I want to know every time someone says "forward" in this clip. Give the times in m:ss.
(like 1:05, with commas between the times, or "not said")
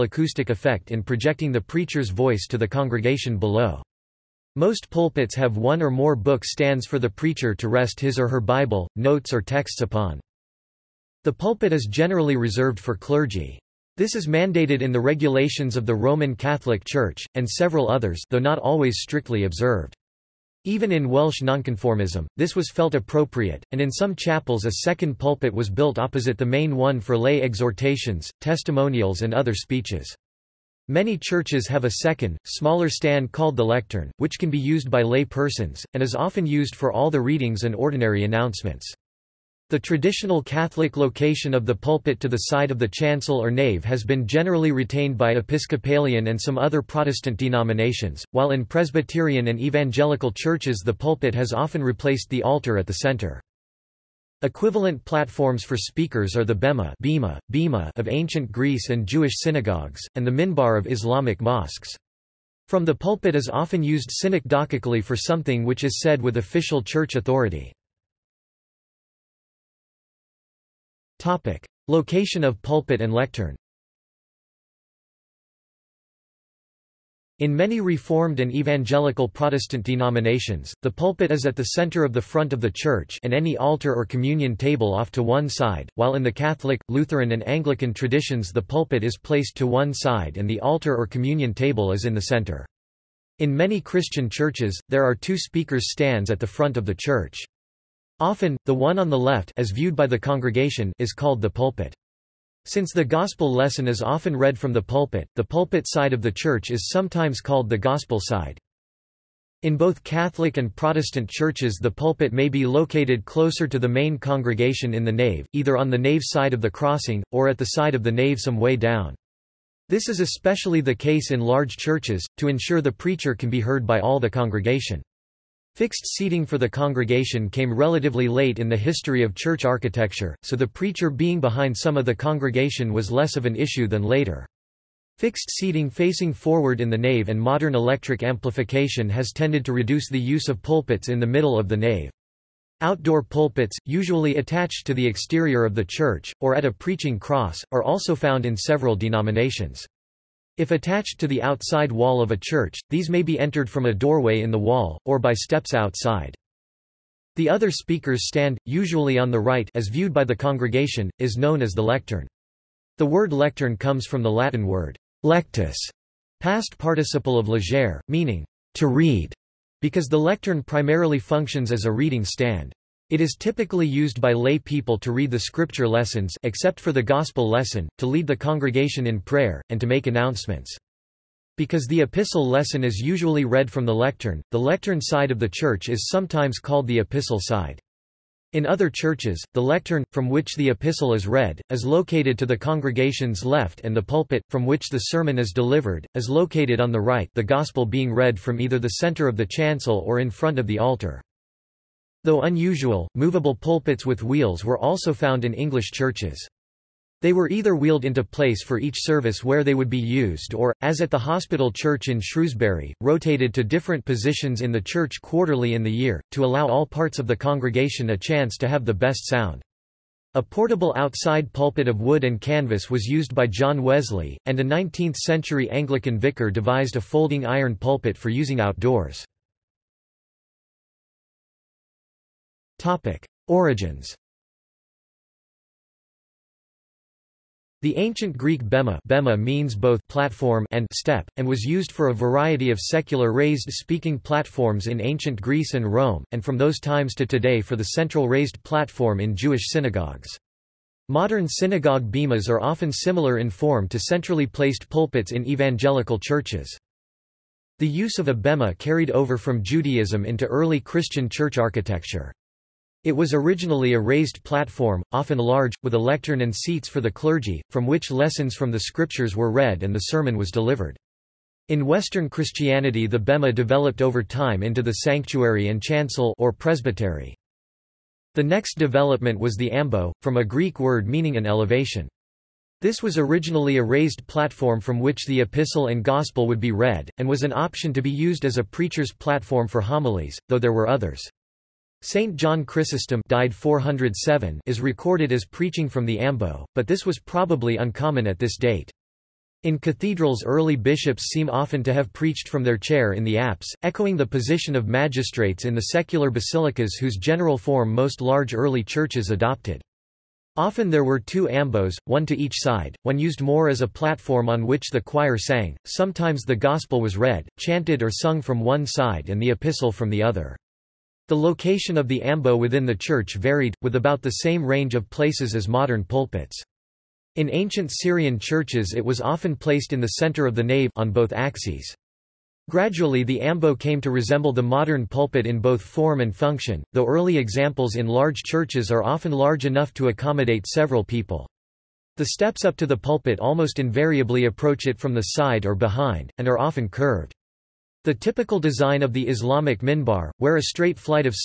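2:16.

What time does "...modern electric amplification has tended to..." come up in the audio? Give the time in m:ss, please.
2:17.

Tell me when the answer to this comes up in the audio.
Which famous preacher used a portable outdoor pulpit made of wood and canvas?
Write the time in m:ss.
3:43.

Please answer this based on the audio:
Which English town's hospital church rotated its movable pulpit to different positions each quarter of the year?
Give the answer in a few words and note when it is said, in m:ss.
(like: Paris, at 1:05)
Shrewsbury, at 3:32.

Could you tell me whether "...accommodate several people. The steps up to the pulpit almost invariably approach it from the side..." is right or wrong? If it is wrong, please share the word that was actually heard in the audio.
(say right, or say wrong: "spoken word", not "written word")
right.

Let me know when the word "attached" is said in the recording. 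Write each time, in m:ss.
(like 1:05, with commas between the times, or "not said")
2:24, 2:30.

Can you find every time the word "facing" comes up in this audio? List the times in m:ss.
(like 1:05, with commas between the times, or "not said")
2:15.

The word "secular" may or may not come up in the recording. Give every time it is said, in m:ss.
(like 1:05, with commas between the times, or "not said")
4:02, 5:05.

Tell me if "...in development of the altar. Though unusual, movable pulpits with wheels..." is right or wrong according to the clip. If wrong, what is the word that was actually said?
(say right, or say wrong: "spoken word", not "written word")
wrong: "front", not "development".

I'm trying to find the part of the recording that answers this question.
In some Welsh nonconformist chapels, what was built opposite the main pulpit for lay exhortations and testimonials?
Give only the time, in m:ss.
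0:24.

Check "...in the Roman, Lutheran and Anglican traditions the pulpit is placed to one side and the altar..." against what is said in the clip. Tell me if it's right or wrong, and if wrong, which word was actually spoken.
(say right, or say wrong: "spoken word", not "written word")
wrong: "Catholic", not "Roman".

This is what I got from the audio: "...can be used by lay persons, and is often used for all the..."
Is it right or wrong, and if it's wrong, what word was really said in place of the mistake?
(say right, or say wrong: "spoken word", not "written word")
right.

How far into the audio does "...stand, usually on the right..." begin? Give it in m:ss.
2:38.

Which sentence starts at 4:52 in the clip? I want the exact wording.
Saint John Chrysostom died 407 is recorded as preaching from the Ambo, but this was probably uncommon at this date.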